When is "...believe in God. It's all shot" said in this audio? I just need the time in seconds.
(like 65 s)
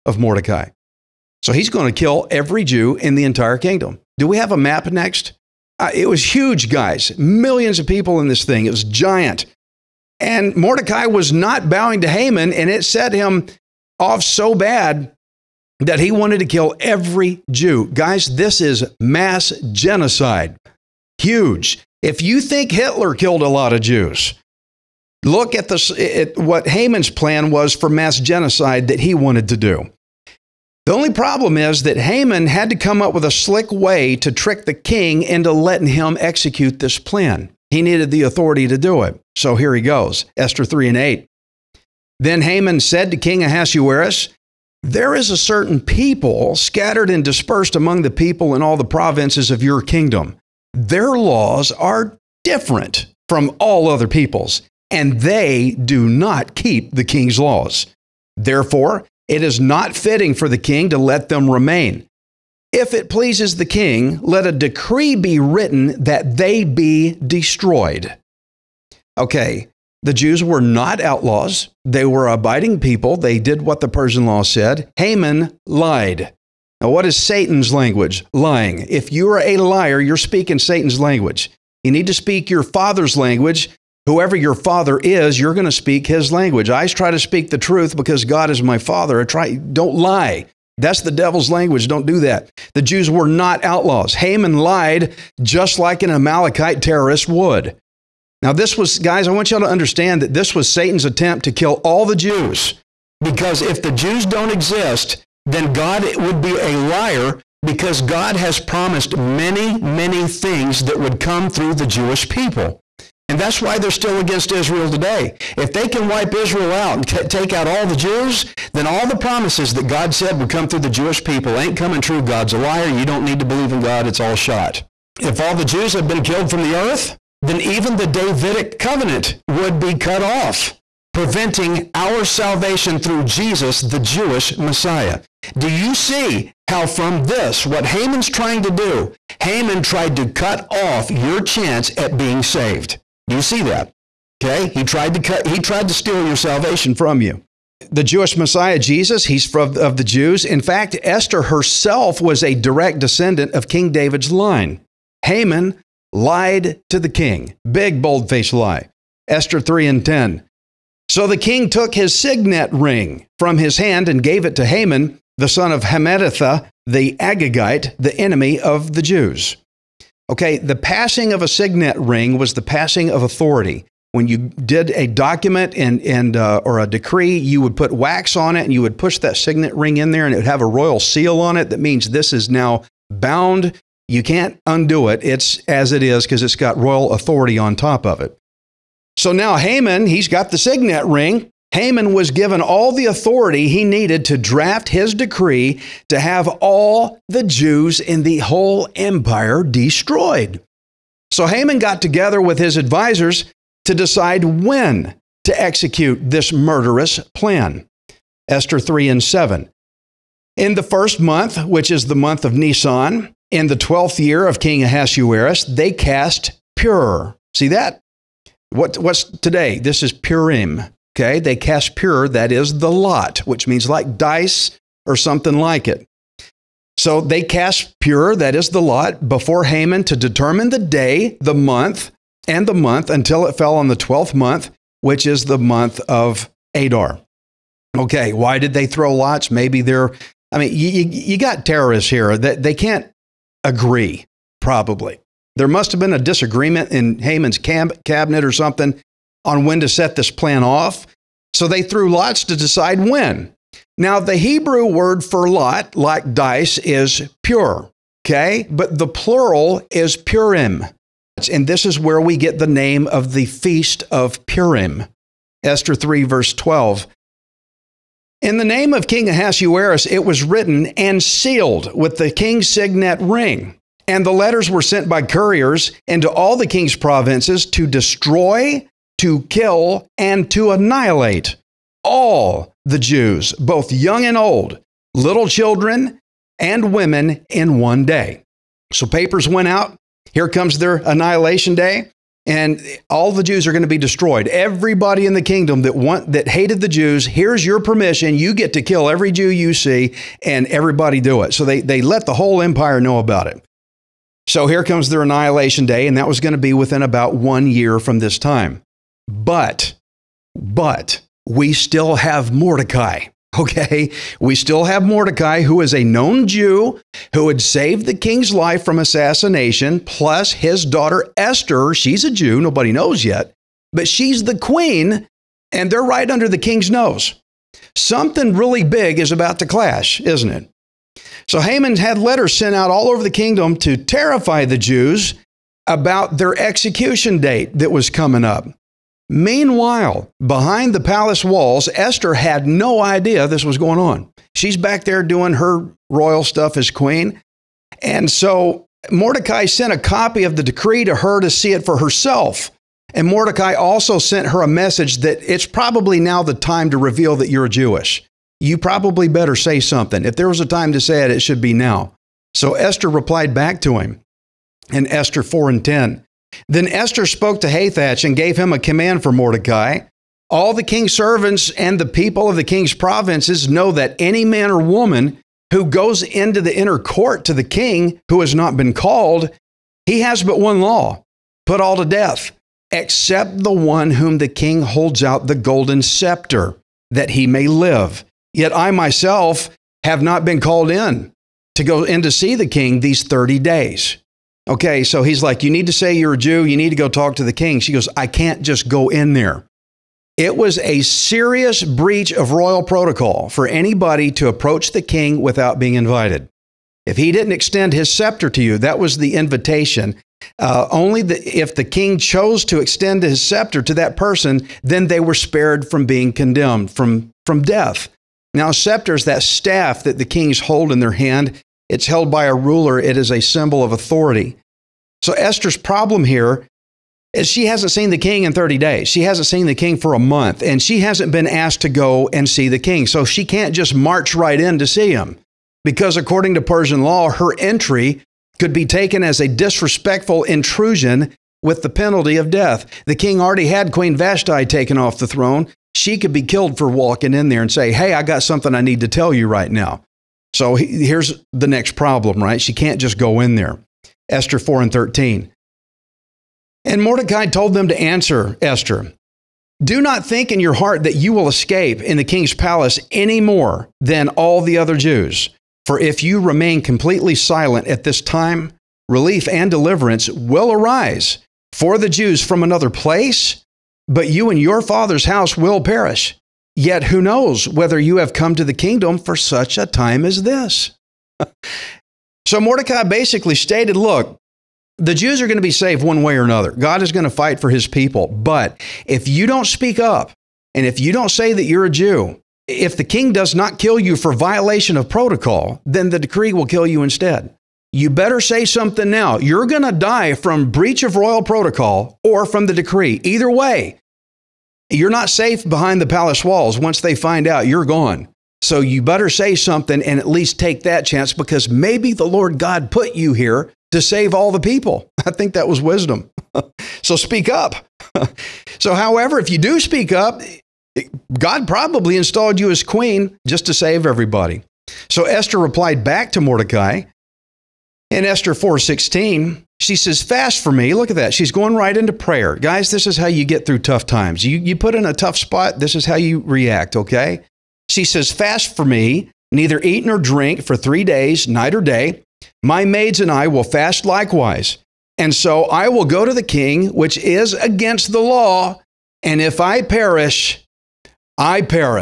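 123 s.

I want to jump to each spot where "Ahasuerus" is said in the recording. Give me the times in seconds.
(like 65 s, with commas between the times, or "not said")
43 s, 214 s, 269 s.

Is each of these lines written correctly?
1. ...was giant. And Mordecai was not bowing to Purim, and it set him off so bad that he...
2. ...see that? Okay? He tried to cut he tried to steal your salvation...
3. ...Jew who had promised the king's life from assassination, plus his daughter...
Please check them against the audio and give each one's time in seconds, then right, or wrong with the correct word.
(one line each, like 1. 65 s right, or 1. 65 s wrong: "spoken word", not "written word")
1. 8 s wrong: "Haman", not "Purim"
2. 143 s right
3. 316 s wrong: "saved", not "promised".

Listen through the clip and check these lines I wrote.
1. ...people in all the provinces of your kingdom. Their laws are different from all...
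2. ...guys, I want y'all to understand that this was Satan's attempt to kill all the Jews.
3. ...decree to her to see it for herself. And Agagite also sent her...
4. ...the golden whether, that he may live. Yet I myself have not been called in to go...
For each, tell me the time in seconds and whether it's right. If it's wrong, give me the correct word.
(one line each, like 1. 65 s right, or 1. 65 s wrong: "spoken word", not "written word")
1. 48 s right
2. 98 s right
3. 350 s wrong: "Mordecai", not "Agagite"
4. 385 s wrong: "scepter", not "whether".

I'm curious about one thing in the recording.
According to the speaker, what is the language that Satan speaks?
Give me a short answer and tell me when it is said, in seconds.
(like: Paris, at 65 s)
Lying, at 78 s.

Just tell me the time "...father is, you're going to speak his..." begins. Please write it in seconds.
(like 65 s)
84 s.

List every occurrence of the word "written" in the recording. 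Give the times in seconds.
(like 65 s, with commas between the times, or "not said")
65 s, 270 s.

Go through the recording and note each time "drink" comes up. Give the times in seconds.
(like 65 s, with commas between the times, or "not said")
540 s.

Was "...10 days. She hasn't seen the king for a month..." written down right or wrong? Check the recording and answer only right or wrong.
wrong.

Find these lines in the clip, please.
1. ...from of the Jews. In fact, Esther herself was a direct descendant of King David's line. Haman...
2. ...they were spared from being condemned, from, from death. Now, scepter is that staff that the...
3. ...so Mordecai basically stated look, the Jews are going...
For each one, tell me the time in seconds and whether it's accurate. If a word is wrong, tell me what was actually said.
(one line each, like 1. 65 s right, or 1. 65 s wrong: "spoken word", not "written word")
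1. 149 s right
2. 415 s right
3. 482 s right.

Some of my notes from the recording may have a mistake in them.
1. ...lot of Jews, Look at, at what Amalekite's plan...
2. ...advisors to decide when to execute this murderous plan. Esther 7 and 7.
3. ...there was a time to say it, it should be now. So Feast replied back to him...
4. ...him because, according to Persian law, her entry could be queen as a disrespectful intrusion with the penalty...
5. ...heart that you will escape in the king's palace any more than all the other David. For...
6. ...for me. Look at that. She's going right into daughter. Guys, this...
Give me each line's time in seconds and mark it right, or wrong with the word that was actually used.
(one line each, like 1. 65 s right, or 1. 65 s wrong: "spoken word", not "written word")
1. 23 s wrong: "Haman", not "Amalekite"
2. 202 s wrong: "3", not "7"
3. 360 s wrong: "Esther", not "Feast"
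4. 435 s wrong: "taken", not "queen"
5. 460 s wrong: "Jews", not "David"
6. 530 s wrong: "prayer", not "daughter".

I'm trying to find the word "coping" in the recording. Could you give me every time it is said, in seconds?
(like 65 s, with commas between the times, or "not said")
not said.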